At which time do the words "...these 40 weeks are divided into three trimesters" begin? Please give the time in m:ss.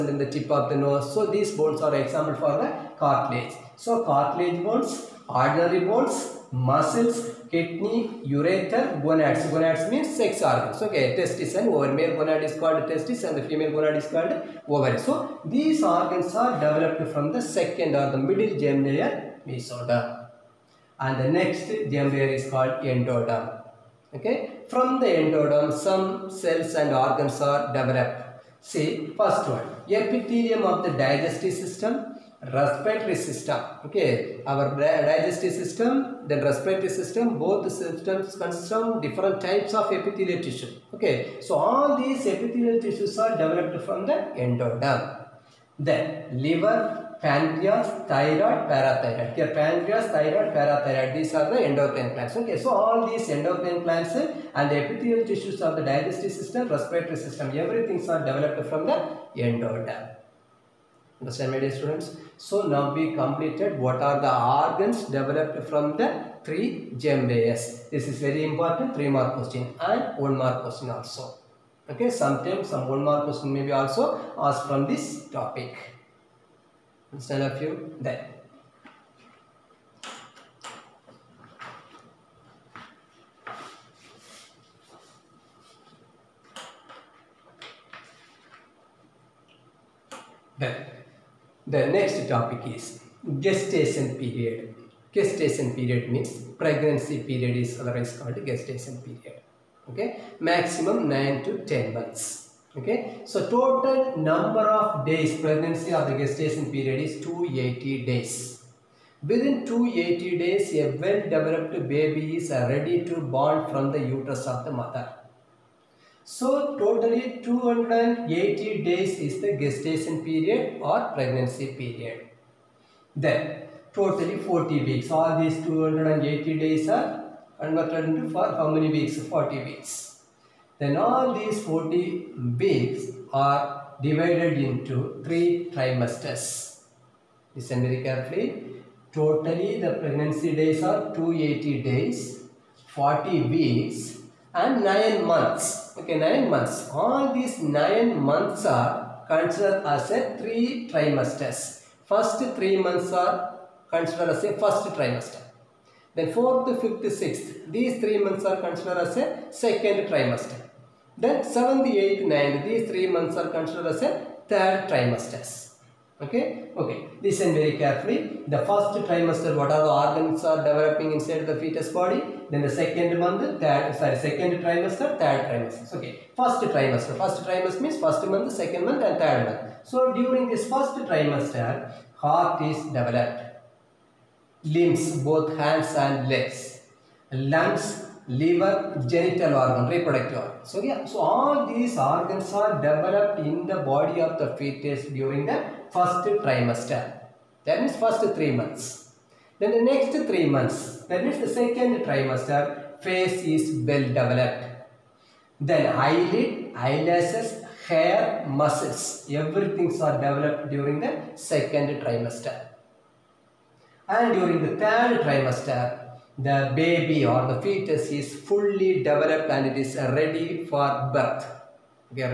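2:11.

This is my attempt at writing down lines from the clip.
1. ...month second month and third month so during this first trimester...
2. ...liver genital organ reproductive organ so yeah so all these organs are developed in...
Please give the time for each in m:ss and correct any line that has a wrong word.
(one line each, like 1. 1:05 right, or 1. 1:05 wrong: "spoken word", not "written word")
1. 2:58 right
2. 3:08 right.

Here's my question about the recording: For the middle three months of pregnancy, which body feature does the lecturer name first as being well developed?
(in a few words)
Face.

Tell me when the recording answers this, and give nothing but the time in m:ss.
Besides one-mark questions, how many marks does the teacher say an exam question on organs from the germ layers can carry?
1:08.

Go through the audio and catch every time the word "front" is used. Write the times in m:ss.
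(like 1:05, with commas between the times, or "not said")
not said.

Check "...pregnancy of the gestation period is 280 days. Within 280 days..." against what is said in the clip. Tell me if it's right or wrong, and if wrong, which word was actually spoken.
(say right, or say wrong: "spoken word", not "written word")
right.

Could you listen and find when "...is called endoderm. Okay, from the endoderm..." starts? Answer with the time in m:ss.
0:22.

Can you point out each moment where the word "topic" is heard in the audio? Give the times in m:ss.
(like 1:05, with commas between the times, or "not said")
1:15, 1:32.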